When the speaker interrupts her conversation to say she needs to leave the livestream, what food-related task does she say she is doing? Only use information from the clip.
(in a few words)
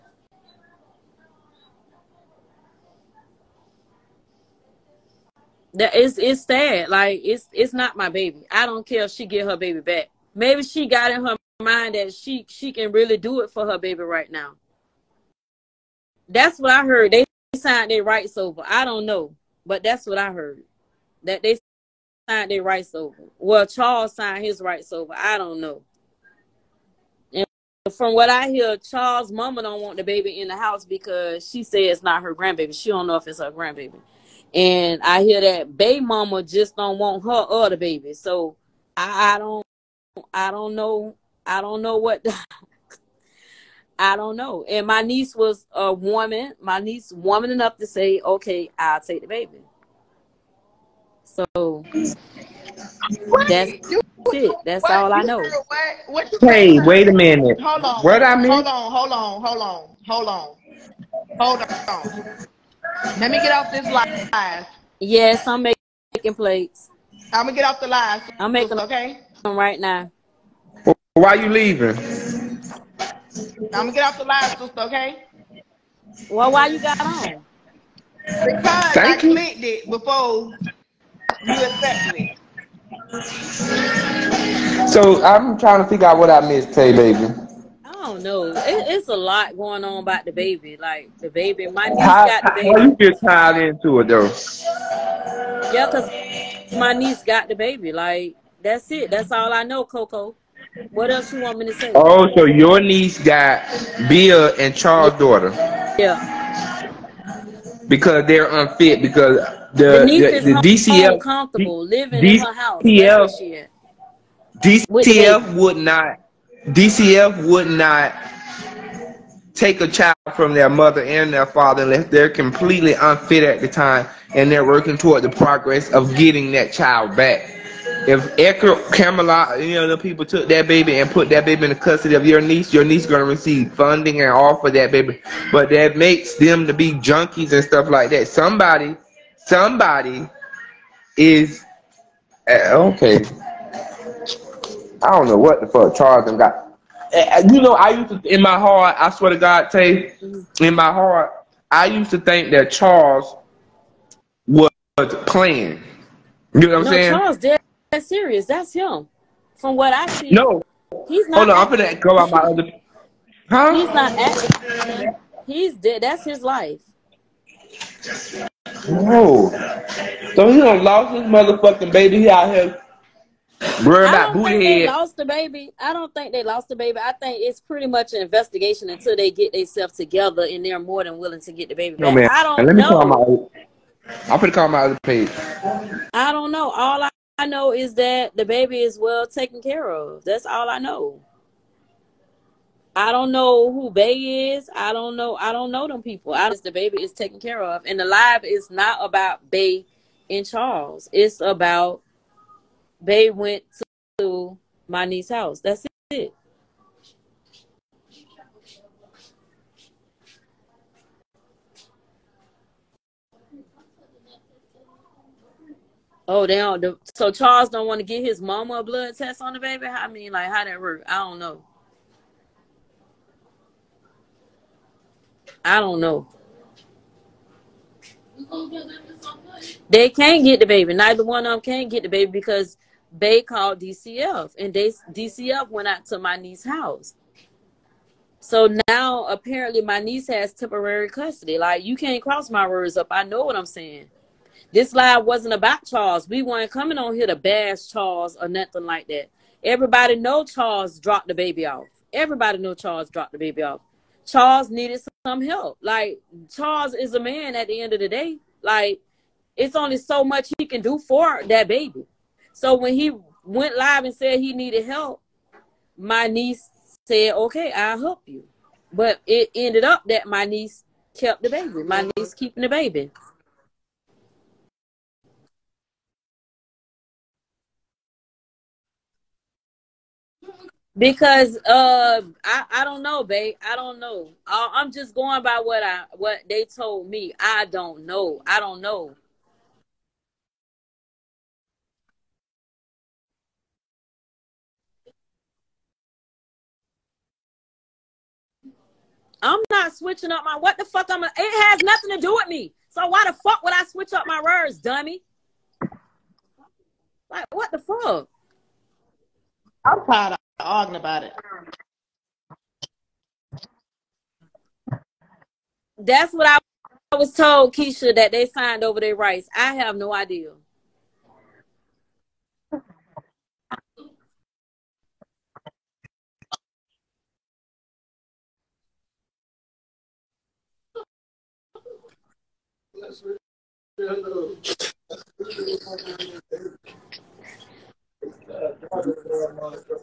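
plates.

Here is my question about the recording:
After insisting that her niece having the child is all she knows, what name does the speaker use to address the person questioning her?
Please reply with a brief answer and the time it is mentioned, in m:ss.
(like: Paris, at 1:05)
Coco, at 1:39.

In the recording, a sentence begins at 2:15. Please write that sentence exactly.
But that makes them to be junkies and stuff like that.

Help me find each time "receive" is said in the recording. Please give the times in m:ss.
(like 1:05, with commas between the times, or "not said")
2:13.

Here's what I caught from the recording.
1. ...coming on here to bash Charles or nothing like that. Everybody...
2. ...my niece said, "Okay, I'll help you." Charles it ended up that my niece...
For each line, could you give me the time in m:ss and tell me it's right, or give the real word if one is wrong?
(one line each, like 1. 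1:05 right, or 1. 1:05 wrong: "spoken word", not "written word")
1. 4:06 right
2. 4:25 wrong: "But", not "Charles".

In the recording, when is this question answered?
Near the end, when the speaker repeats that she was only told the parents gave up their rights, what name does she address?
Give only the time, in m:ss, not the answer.
5:17.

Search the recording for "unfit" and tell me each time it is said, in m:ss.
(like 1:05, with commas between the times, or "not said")
1:48, 2:02.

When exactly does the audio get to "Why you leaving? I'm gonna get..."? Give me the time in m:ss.
1:11.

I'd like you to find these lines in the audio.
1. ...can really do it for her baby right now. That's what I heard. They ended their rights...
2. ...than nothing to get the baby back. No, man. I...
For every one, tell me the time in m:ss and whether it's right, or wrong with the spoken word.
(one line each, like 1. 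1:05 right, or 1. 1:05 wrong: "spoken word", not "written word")
1. 0:12 wrong: "signed", not "ended"
2. 3:01 wrong: "willing", not "nothing".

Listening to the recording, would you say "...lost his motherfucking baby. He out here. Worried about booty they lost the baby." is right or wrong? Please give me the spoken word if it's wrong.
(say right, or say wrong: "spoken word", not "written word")
right.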